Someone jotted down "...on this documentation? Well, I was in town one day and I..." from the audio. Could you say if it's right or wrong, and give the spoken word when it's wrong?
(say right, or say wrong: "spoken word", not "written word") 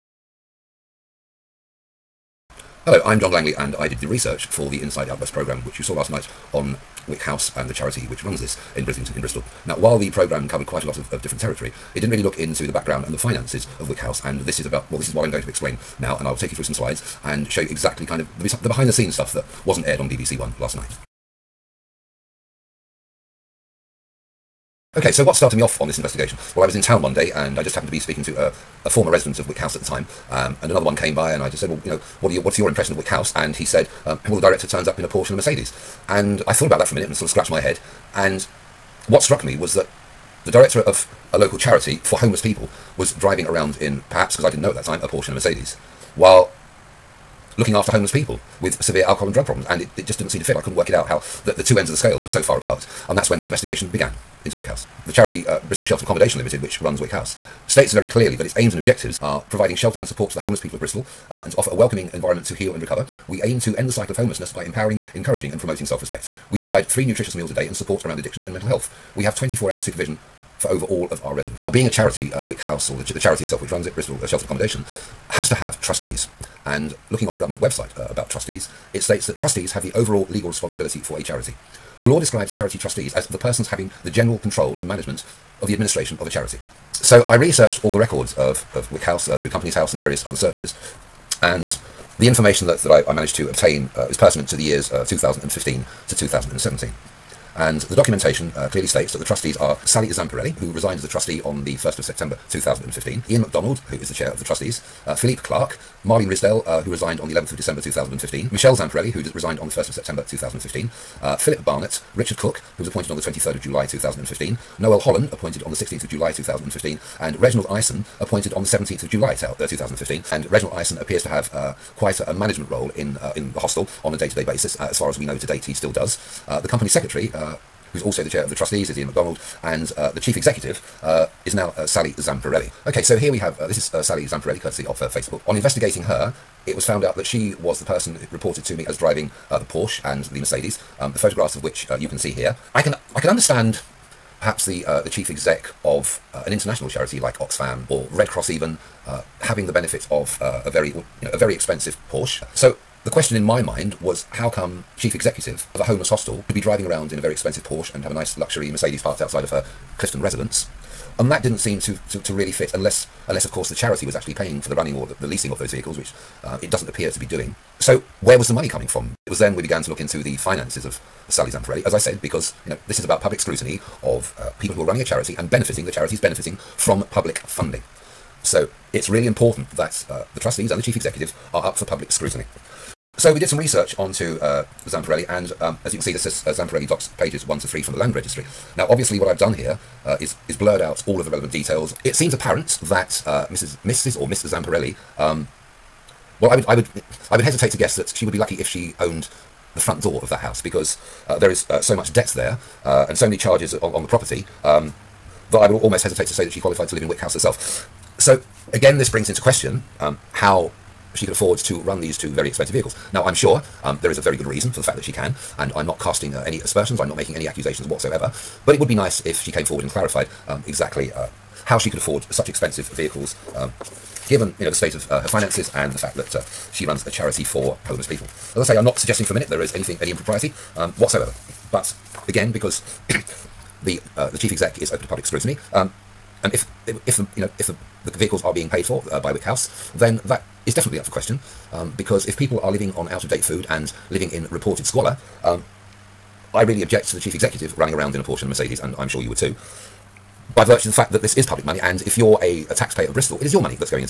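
wrong: "investigation", not "documentation".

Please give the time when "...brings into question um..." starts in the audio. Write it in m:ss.
3:29.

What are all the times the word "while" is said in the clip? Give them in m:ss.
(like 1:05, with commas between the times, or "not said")
0:09, 0:46.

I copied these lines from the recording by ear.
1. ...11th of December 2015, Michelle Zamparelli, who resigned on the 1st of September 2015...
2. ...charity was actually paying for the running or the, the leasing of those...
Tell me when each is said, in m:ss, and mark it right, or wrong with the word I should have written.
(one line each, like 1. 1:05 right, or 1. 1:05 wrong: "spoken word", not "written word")
1. 1:47 right
2. 2:43 right.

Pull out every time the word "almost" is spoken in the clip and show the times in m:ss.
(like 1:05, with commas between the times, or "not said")
3:25.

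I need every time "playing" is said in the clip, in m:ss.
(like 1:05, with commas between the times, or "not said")
not said.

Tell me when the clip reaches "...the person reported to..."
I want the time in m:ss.
2:17.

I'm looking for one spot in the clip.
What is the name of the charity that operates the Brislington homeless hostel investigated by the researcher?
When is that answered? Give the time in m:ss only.
0:55.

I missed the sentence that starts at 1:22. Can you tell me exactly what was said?
The law describes charity trustees as the persons having the general control and management of the administration of a charity.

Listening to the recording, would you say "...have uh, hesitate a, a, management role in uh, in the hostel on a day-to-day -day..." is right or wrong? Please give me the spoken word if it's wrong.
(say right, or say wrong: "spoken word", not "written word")
wrong: "quite", not "hesitate".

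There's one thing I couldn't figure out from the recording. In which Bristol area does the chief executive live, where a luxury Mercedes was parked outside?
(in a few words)
Clifton.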